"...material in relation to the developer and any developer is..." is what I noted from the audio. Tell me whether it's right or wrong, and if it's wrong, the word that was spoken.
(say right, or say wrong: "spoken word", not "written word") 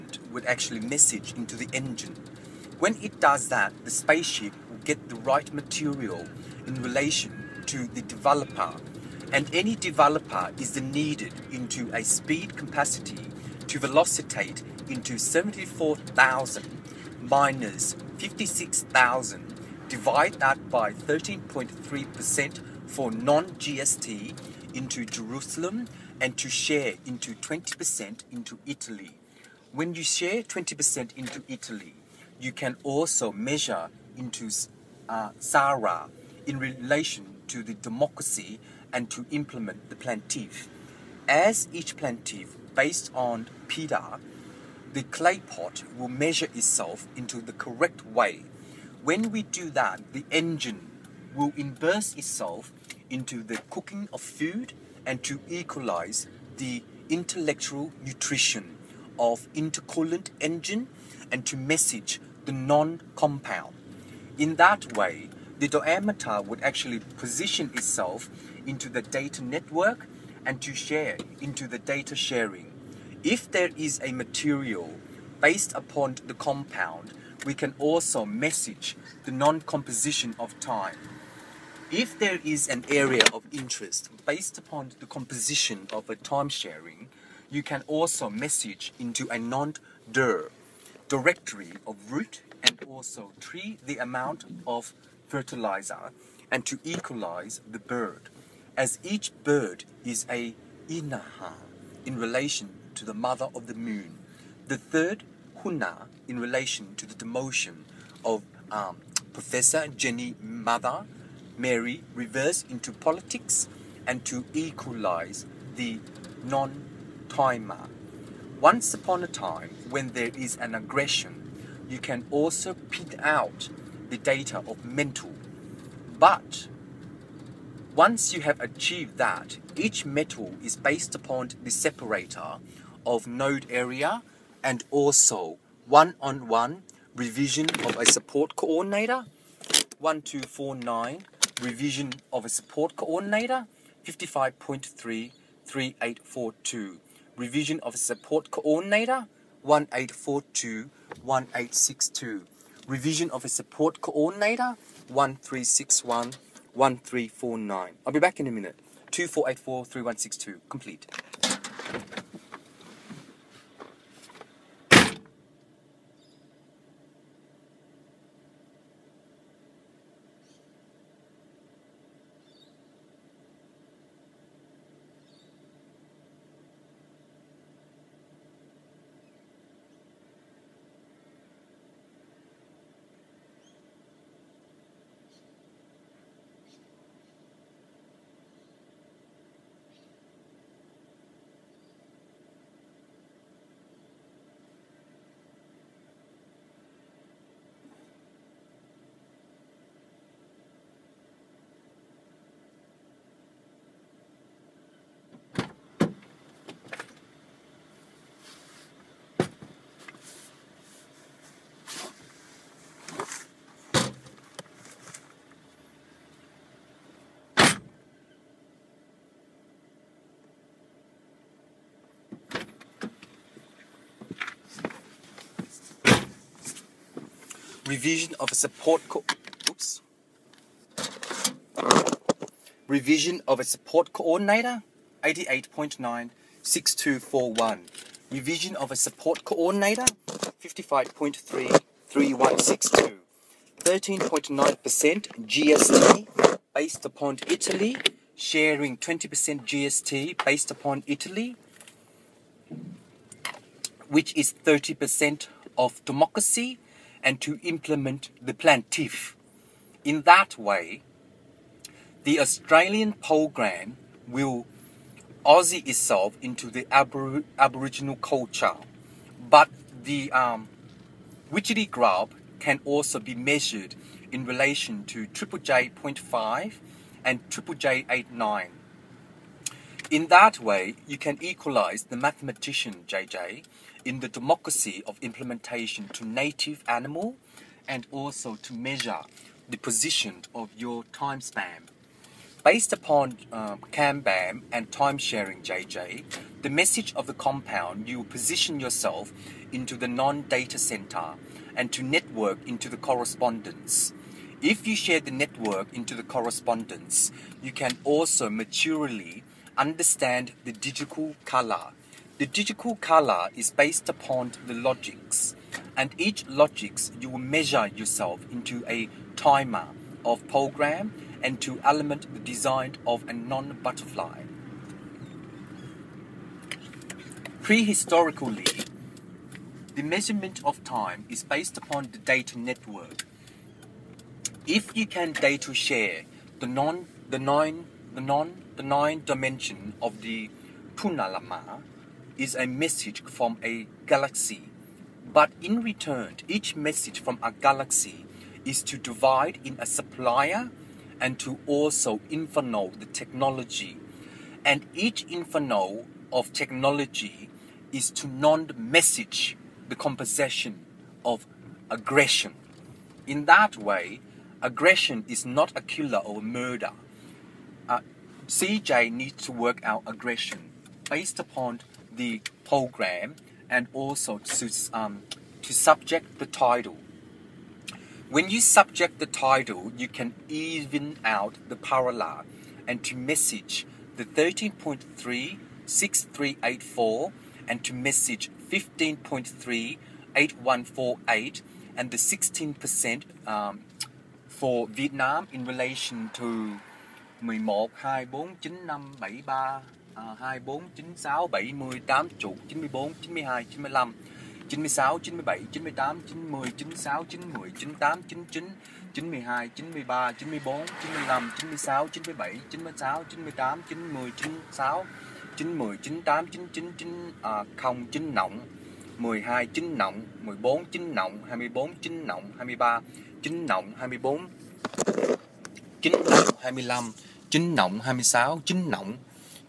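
right.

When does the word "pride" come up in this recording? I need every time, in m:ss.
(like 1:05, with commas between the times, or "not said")
not said.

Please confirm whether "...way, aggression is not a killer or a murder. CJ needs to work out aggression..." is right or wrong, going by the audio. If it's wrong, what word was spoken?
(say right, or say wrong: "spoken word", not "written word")
right.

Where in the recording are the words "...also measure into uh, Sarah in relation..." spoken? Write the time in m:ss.
0:32.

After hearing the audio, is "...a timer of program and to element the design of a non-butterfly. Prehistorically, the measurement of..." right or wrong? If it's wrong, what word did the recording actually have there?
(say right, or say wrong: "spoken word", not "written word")
right.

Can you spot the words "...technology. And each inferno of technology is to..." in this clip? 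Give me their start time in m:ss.
5:53.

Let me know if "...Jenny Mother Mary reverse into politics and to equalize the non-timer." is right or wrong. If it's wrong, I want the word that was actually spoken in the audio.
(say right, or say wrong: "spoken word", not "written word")
right.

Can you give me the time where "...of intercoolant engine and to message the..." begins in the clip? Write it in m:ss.
0:59.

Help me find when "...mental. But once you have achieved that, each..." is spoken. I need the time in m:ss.
2:04.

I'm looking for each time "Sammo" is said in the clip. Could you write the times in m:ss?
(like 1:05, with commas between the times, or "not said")
not said.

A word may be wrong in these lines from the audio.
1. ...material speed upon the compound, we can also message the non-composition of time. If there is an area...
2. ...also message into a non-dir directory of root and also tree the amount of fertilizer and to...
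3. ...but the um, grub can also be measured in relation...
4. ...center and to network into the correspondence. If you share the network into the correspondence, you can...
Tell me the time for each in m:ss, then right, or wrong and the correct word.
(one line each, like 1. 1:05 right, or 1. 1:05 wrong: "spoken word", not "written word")
1. 1:14 wrong: "based", not "speed"
2. 1:27 right
3. 4:29 right
4. 5:00 right.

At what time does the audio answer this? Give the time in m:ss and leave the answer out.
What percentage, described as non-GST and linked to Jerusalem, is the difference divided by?
0:20.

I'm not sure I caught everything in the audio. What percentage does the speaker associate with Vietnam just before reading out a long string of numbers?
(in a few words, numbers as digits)
16%.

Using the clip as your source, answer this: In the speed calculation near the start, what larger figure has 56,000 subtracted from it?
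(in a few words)
74,000.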